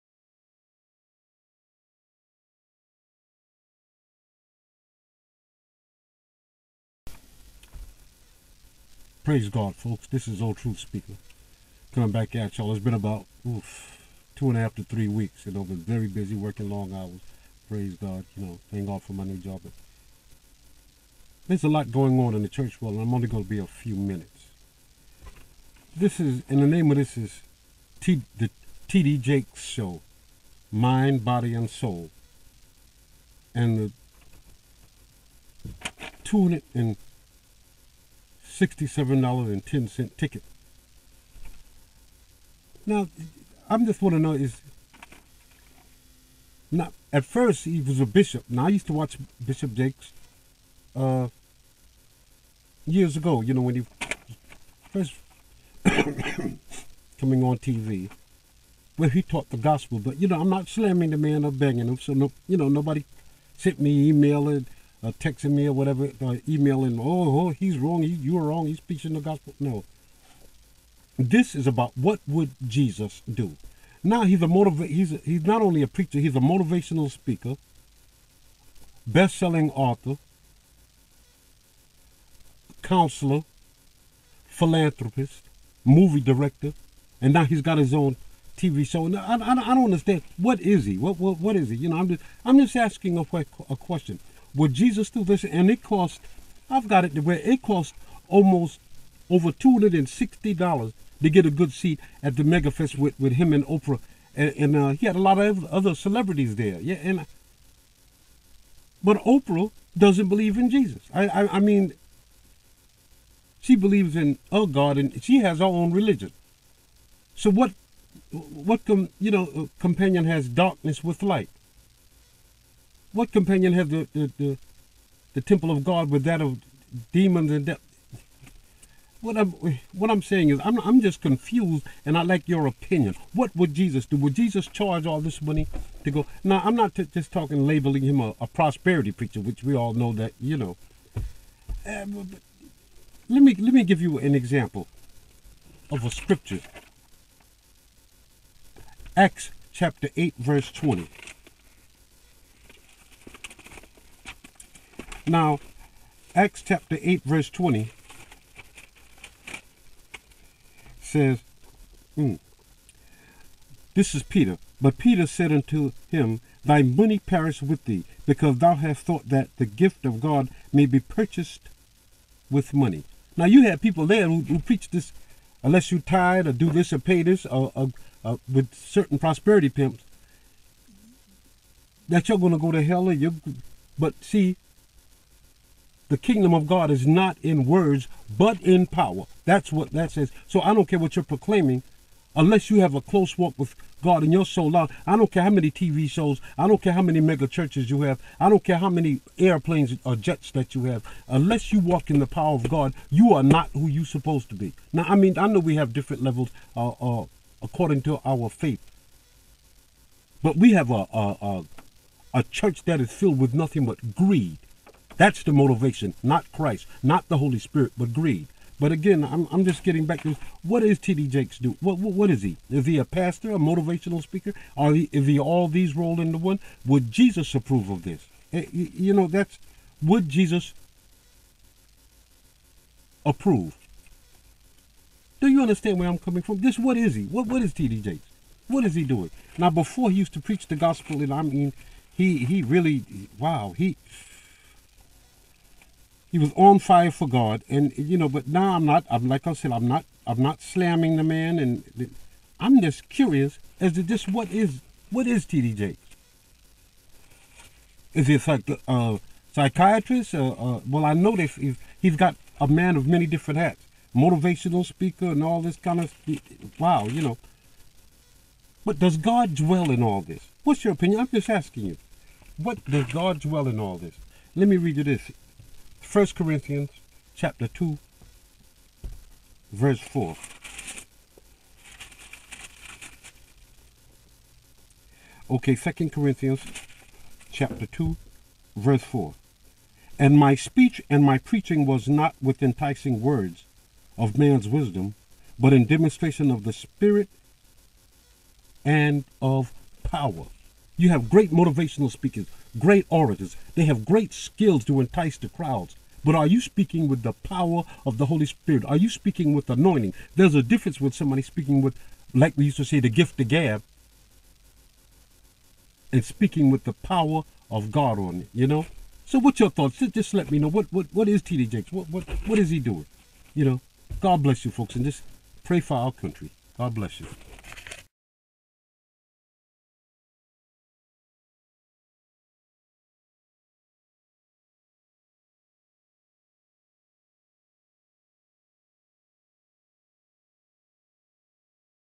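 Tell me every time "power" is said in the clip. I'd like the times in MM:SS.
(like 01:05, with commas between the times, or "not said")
03:08, 03:22, 05:00, 05:07, 05:16.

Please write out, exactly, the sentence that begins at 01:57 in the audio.
So what, what com, you know, companion has darkness with light?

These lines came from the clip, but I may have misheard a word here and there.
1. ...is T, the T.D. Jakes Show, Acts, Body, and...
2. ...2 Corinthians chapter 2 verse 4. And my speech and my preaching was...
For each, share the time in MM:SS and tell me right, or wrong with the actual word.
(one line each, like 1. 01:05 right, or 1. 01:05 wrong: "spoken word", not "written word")
1. 00:27 wrong: "Mind", not "Acts"
2. 04:45 right.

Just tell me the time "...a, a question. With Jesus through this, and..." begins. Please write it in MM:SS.
01:33.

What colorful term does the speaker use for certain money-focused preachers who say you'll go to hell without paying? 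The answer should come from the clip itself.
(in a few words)
prosperity pimps.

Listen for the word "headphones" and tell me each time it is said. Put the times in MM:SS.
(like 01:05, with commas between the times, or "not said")
not said.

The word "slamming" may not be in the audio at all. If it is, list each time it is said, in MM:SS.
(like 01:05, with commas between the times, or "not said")
01:00, 04:10.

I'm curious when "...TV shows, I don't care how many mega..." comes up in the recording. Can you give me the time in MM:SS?
03:15.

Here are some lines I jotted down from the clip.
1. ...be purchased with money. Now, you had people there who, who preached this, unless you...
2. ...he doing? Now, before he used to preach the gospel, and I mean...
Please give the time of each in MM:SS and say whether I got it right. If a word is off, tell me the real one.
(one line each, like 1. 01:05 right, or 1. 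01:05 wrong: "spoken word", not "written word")
1. 02:50 right
2. 03:58 right.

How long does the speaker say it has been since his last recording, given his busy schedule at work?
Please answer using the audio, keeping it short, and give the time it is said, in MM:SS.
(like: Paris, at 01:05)
2.5 to 3 weeks, at 00:14.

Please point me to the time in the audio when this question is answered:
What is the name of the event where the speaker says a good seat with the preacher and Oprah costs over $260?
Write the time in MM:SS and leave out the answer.
01:42.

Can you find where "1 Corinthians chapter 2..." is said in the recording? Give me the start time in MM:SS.
04:36.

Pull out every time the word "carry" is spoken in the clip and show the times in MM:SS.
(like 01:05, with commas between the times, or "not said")
not said.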